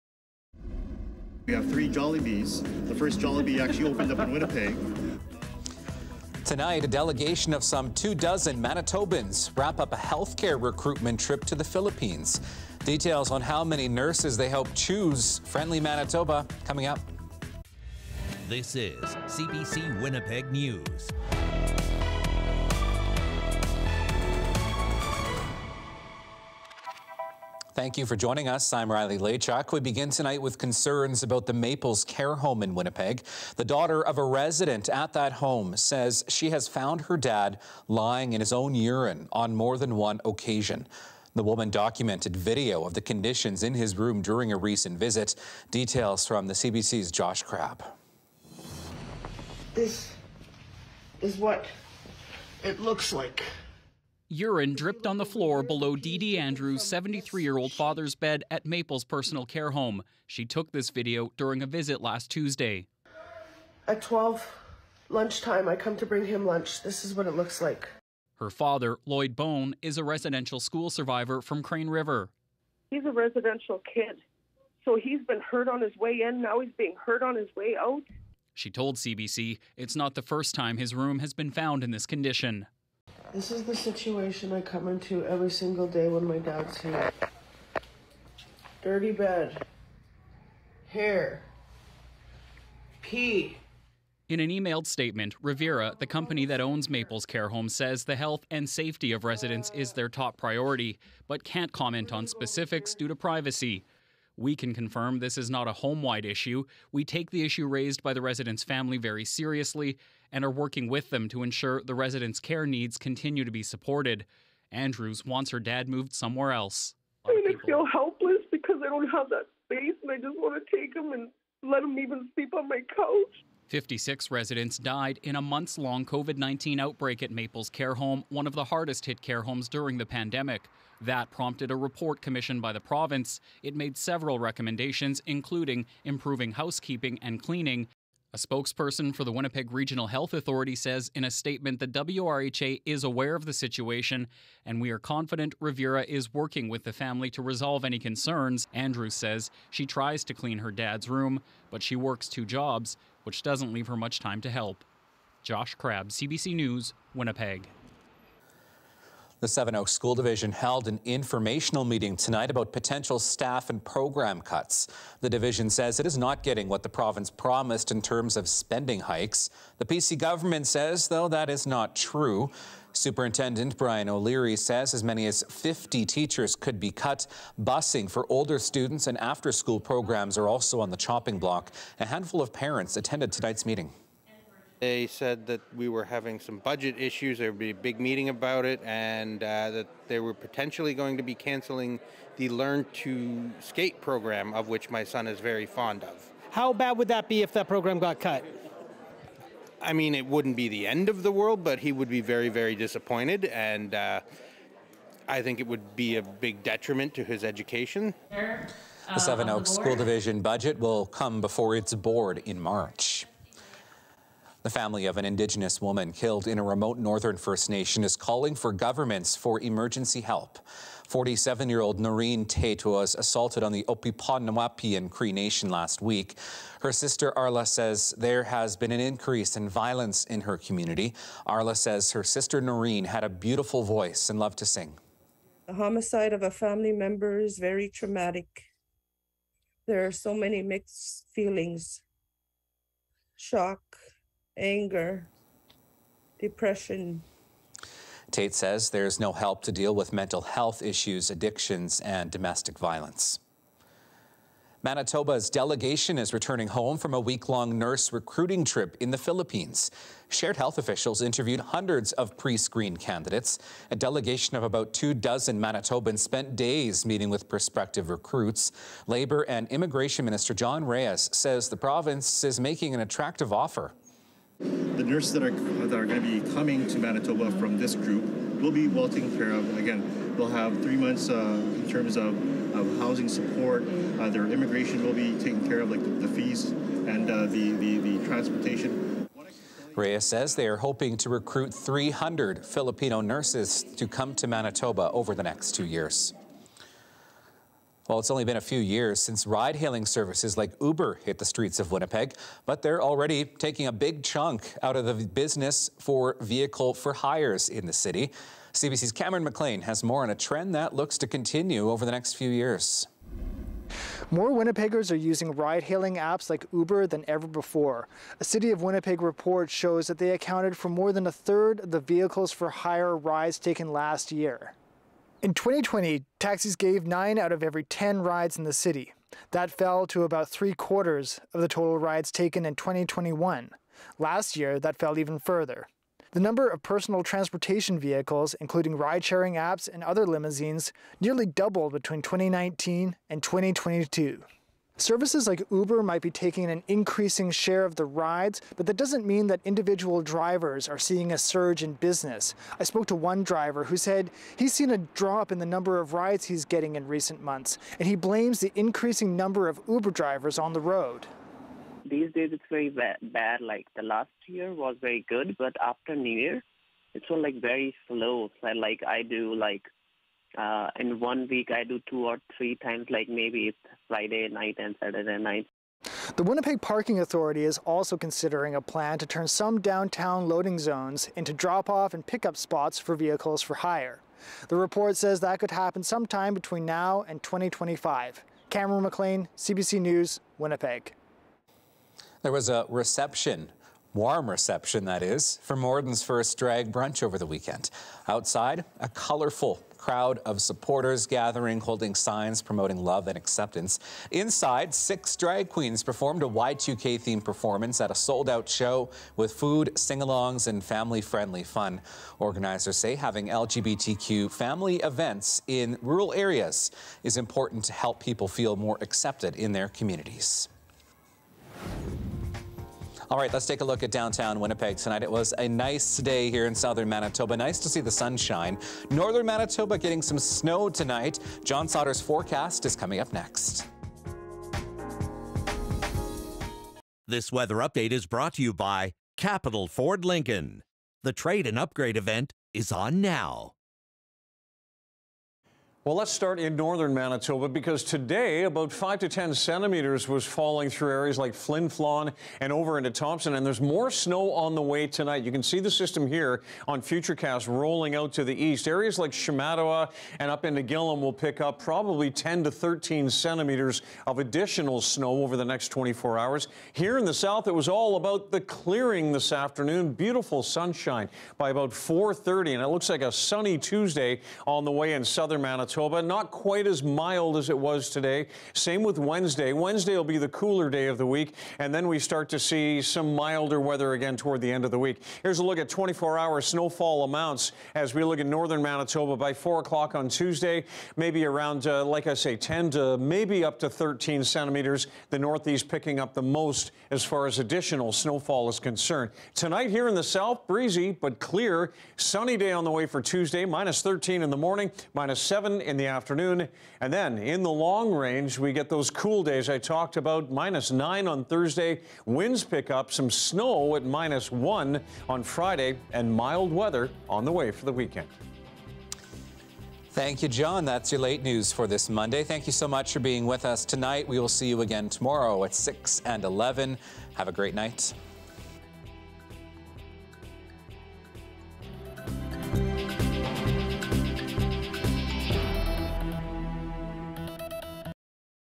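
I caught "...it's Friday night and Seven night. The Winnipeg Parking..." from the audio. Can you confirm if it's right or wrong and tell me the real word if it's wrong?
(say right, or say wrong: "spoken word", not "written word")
wrong: "Saturday", not "Seven".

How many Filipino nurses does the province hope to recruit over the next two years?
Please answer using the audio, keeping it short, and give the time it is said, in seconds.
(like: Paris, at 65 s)
300, at 291 s.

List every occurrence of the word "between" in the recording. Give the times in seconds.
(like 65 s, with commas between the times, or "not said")
341 s, 386 s.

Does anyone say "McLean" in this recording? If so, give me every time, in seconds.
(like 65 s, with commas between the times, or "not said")
309 s, 389 s.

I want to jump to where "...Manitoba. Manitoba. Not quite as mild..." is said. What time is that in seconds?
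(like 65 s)
475 s.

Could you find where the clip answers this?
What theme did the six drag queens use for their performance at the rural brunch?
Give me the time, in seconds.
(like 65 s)
406 s.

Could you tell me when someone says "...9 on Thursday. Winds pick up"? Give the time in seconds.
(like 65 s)
510 s.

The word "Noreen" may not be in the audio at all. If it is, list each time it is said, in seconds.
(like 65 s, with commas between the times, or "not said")
221 s, 232 s.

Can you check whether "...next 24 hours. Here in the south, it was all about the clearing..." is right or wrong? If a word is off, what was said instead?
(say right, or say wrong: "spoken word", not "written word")
right.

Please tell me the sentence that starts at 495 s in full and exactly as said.
The northeast picking up the most as far as additional snowfall is concerned.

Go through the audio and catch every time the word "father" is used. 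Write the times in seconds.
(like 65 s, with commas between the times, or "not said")
57 s, 68 s.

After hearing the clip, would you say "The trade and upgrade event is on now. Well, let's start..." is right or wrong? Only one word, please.
right.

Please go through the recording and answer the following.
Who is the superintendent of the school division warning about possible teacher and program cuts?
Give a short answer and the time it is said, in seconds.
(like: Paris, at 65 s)
Brian O'Leary, at 173 s.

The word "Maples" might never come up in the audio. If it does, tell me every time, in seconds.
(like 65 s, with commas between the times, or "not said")
31 s, 58 s, 96 s, 127 s.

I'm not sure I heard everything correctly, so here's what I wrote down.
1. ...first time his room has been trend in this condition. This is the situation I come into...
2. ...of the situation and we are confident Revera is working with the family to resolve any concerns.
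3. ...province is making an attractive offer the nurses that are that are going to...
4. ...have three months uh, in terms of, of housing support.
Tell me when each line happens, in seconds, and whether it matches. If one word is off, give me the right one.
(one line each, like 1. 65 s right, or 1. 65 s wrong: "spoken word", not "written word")
1. 80 s wrong: "found", not "trend"
2. 143 s right
3. 271 s right
4. 280 s right.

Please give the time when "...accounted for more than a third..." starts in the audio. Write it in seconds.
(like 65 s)
320 s.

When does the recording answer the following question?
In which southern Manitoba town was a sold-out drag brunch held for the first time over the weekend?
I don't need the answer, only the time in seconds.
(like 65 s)
395 s.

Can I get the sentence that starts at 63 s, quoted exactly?
At 12, lunchtime, I come to bring him lunch.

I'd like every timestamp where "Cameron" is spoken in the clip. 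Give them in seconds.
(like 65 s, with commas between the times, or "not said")
309 s, 388 s.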